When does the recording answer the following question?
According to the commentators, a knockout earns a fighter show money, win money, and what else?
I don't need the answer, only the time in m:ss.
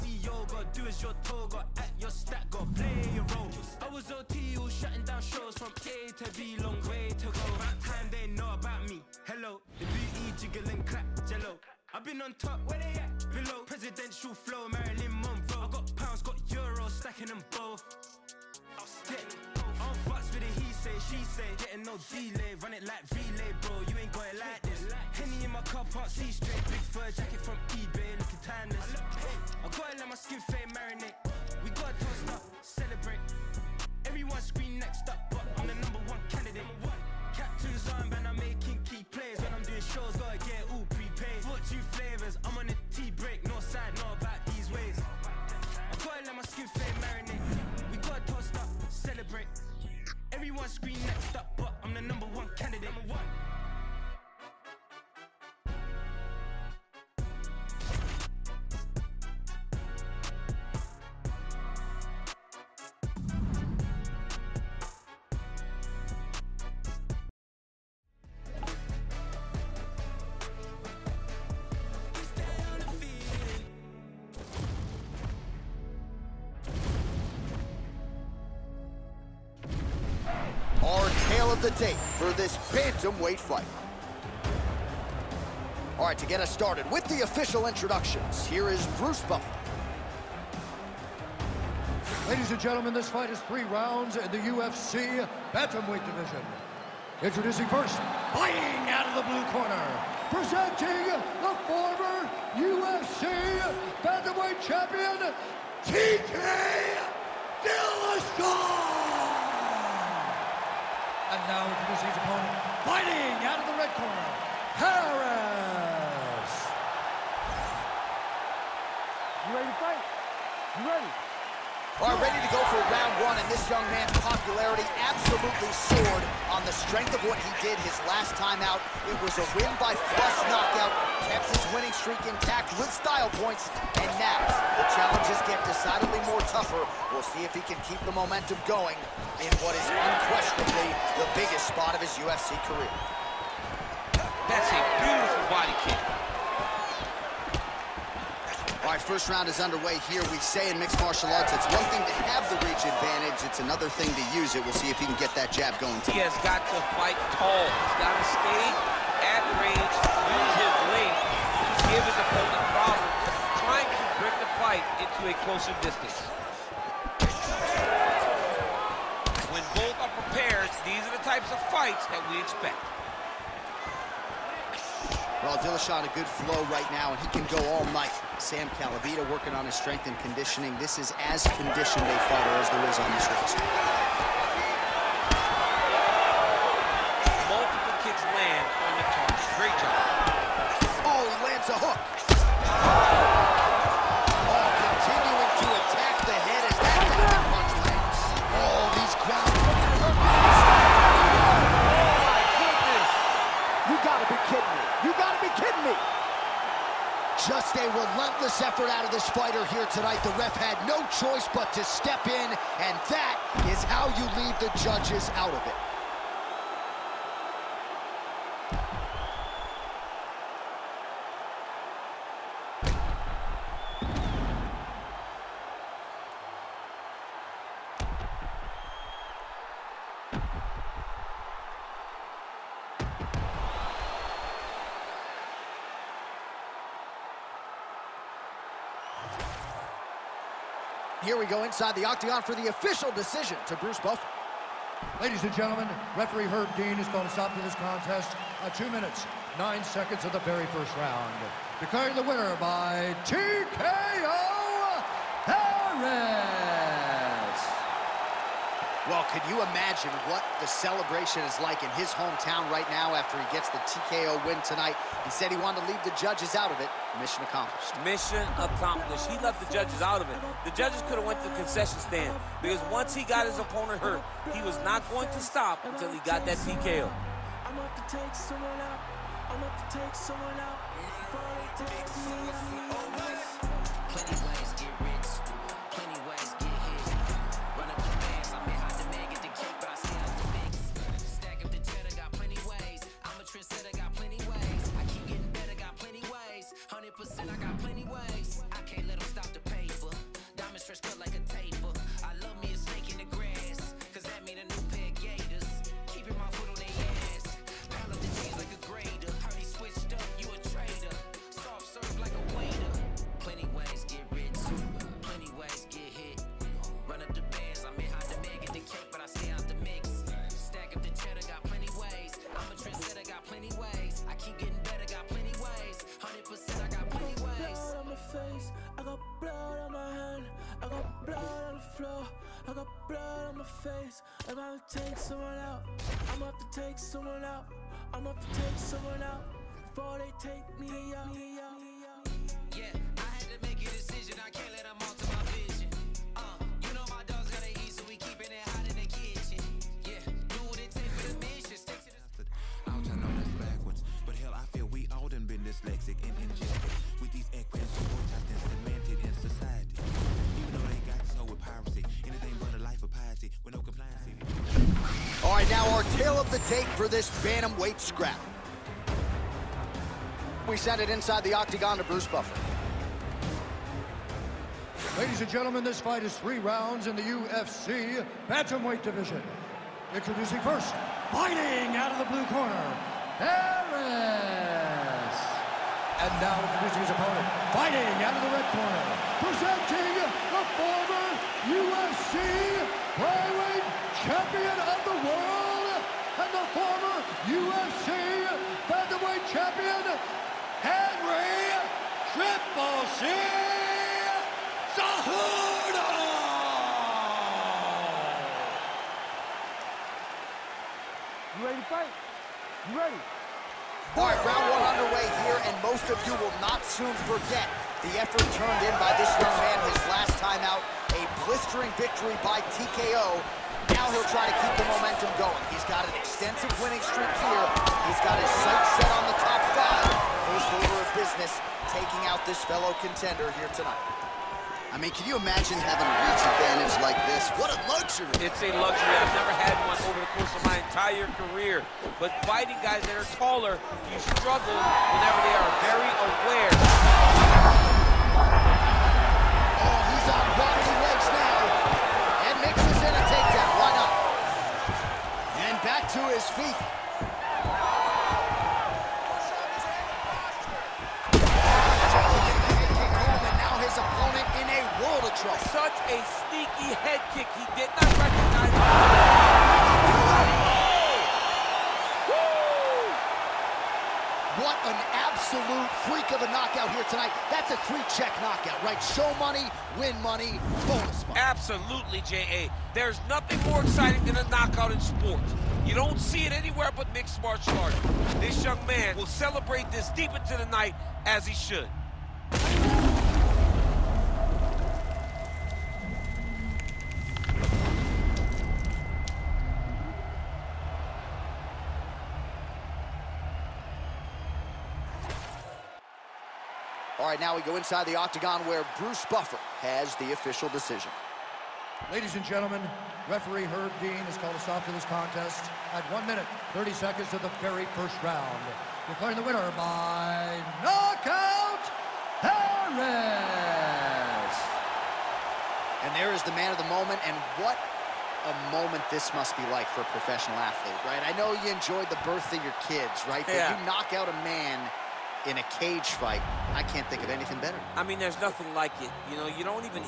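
8:00.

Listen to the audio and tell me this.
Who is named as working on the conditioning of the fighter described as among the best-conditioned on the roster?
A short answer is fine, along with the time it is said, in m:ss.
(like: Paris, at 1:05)
Sam Calavitta, at 2:58.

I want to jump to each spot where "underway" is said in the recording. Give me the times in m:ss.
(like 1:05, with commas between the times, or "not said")
2:29, 6:55.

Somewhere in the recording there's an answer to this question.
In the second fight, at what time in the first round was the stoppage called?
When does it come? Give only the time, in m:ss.
8:36.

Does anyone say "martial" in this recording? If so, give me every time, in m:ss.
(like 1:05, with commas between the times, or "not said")
2:31, 8:07.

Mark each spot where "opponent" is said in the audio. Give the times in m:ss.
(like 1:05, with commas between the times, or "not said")
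1:52, 2:42, 4:33, 6:27.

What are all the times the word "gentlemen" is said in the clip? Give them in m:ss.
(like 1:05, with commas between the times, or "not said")
1:32, 4:05, 6:15, 8:32.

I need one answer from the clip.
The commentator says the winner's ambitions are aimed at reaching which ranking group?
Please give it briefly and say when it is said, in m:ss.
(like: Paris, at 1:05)
Top five, at 7:09.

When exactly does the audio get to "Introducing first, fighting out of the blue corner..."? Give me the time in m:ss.
6:20.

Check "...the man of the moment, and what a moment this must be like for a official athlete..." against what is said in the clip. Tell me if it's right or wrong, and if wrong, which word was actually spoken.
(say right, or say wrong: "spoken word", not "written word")
wrong: "professional", not "official".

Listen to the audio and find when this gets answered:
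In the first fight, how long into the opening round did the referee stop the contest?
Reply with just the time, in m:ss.
4:08.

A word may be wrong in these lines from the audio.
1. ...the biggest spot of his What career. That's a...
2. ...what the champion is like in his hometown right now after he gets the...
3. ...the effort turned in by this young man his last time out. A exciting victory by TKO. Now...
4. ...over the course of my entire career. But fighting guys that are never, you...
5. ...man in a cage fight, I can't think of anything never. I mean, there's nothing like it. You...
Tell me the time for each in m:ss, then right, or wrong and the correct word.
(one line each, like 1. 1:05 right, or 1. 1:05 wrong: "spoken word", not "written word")
1. 2:21 wrong: "UFC", not "What"
2. 4:20 wrong: "celebration", not "champion"
3. 6:58 wrong: "blistering", not "exciting"
4. 7:20 wrong: "taller", not "never"
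5. 8:54 wrong: "better", not "never".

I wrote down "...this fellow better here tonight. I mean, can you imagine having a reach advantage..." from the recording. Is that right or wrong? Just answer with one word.
wrong.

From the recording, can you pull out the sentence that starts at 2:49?
When both are prepared, these are the types of fights that we expect.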